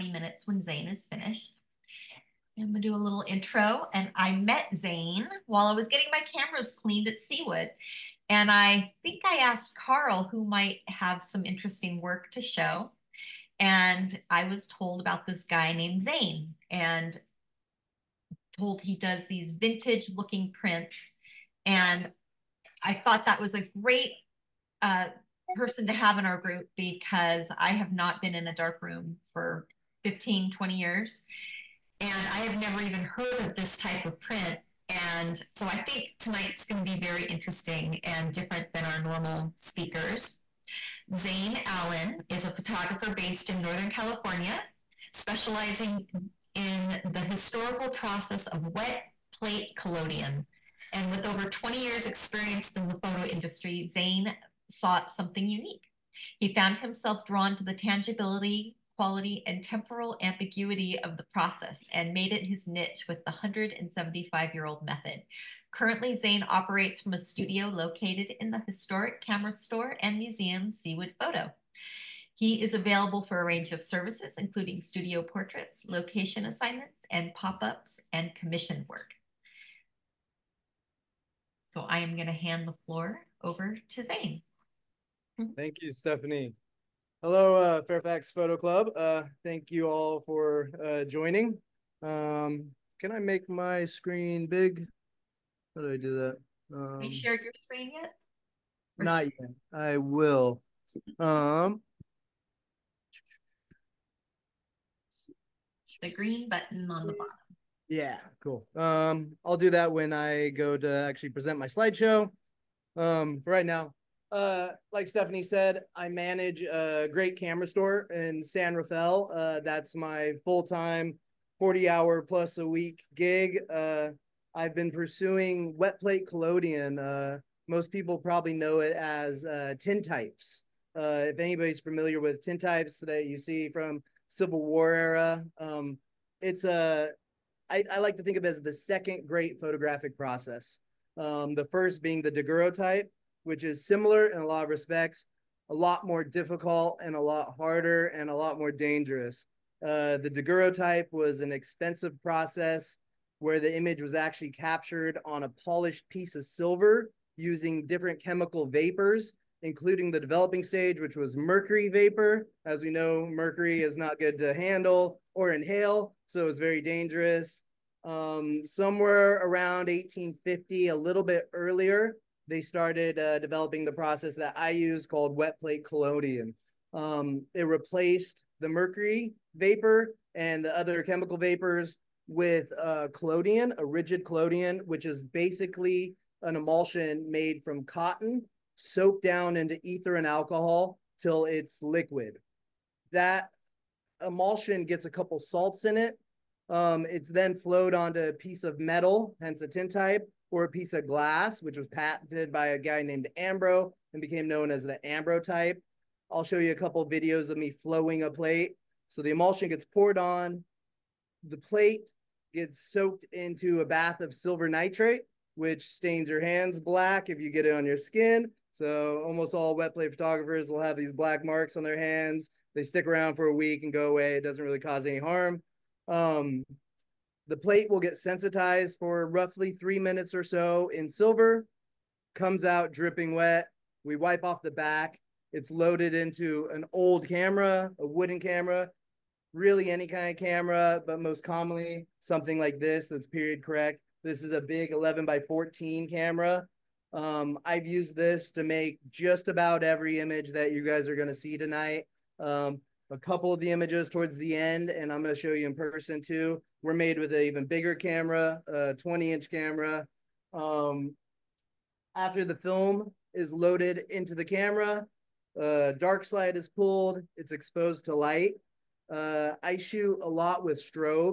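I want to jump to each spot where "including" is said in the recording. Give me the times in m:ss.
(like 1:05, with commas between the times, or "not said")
1:14, 2:39.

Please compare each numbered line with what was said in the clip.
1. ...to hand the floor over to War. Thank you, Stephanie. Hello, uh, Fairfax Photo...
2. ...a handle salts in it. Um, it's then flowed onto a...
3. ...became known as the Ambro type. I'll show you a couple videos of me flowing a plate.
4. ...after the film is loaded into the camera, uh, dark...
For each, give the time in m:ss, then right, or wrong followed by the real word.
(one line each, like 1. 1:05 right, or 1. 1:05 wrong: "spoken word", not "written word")
1. 1:22 wrong: "Zane", not "War"
2. 3:15 wrong: "couple", not "handle"
3. 3:24 right
4. 4:22 right.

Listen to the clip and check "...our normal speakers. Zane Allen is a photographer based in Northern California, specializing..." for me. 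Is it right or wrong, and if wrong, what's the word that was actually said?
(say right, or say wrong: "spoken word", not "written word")
right.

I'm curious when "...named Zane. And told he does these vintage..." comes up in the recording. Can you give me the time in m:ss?
0:15.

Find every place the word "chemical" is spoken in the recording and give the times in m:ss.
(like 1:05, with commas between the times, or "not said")
2:38, 3:01.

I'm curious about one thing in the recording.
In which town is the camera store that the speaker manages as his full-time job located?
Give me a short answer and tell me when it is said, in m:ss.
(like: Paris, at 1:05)
San Rafael, at 1:58.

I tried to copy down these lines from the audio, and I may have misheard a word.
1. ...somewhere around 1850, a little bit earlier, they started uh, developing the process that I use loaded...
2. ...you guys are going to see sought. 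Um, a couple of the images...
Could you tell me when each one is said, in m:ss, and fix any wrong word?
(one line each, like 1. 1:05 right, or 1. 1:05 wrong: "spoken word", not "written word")
1. 2:48 wrong: "called", not "loaded"
2. 4:10 wrong: "tonight", not "sought".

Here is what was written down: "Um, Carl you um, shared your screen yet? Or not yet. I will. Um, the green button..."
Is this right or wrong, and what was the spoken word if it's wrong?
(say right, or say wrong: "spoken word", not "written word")
wrong: "Have", not "Carl".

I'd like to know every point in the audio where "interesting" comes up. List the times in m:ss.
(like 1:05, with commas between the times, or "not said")
0:11, 0:37.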